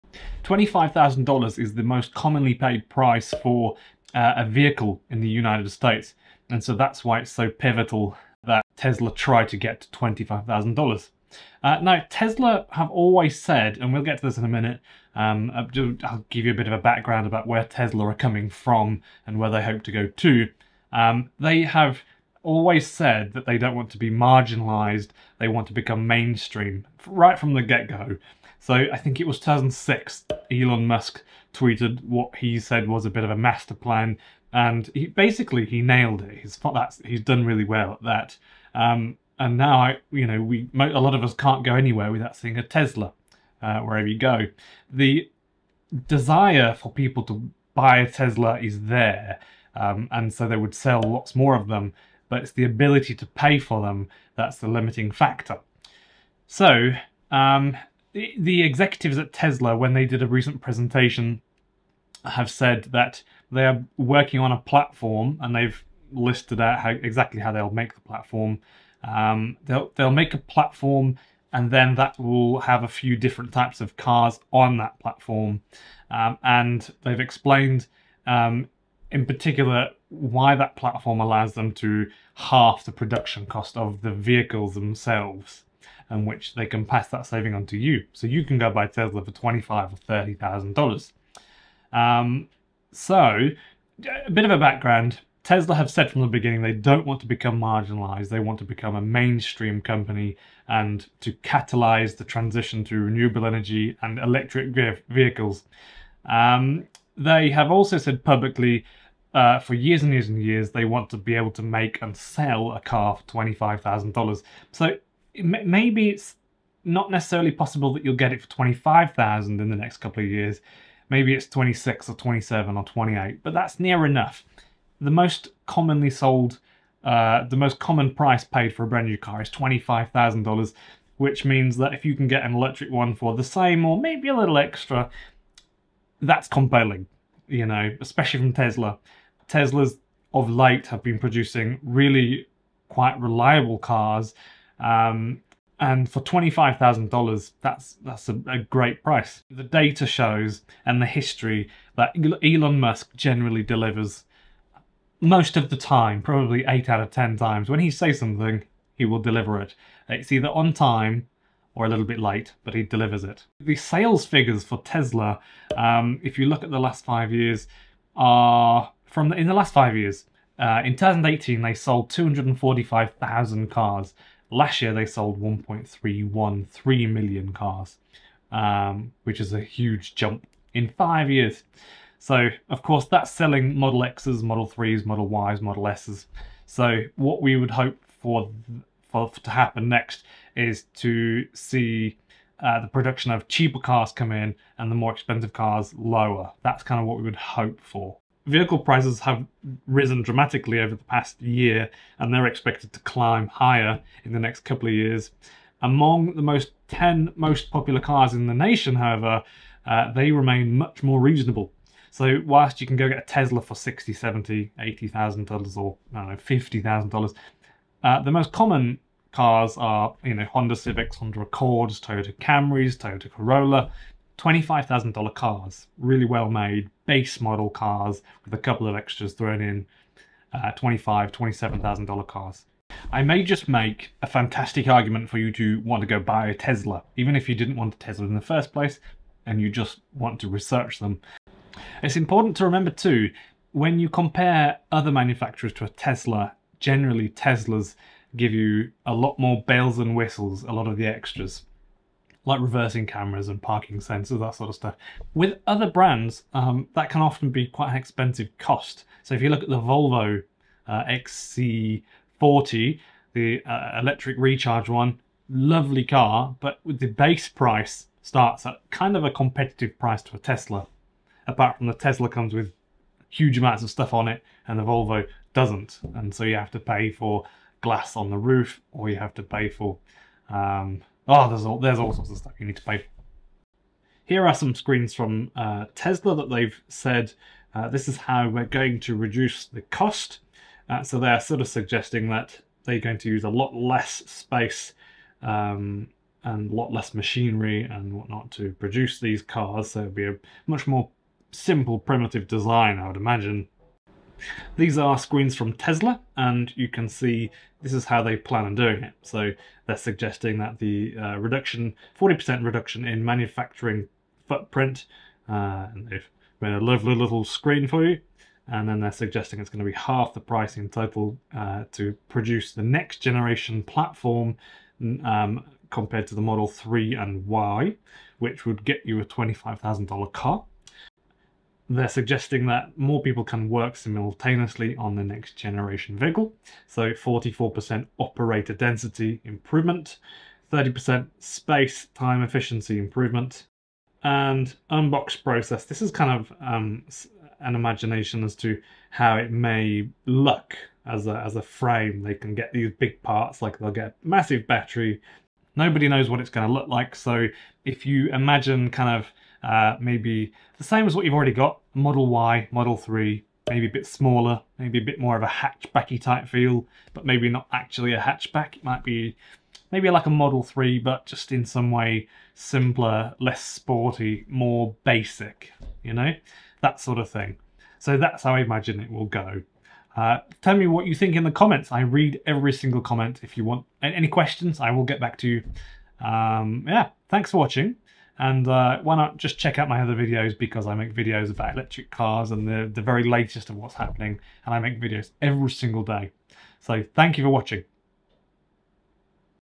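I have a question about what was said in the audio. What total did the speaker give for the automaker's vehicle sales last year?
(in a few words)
1.313 million.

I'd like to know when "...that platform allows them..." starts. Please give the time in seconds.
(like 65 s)
80 s.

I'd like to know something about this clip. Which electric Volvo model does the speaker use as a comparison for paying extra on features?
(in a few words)
XC40.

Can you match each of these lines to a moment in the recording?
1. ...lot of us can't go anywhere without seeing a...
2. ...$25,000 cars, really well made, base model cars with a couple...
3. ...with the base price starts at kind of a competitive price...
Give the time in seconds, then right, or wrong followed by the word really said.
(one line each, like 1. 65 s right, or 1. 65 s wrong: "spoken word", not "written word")
1. 40 s right
2. 224 s right
3. 266 s right.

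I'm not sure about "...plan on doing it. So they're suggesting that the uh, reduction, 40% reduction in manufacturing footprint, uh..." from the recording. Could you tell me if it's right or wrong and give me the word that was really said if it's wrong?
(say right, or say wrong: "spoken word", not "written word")
right.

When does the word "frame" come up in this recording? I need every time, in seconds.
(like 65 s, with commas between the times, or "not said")
351 s.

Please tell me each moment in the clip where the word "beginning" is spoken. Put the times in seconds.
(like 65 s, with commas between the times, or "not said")
96 s.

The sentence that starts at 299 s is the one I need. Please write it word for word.
So it'd be a much more simple primitive design, I would imagine.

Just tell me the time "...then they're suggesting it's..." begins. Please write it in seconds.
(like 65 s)
318 s.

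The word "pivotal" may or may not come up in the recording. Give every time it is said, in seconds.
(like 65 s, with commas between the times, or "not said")
7 s.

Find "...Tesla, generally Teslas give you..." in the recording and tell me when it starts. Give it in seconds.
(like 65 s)
245 s.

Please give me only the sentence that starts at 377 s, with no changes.
So that's how I imagine it will go.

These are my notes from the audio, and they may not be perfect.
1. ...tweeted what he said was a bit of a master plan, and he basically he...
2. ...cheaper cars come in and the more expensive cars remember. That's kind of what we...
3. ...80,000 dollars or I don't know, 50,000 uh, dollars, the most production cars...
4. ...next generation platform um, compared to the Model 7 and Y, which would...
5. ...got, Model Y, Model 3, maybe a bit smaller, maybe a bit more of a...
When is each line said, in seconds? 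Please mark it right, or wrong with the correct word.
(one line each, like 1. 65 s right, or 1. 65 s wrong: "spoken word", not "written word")
1. 31 s right
2. 193 s wrong: "lower", not "remember"
3. 214 s wrong: "common", not "production"
4. 322 s wrong: "3", not "7"
5. 361 s right.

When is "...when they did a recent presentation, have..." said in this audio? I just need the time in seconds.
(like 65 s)
59 s.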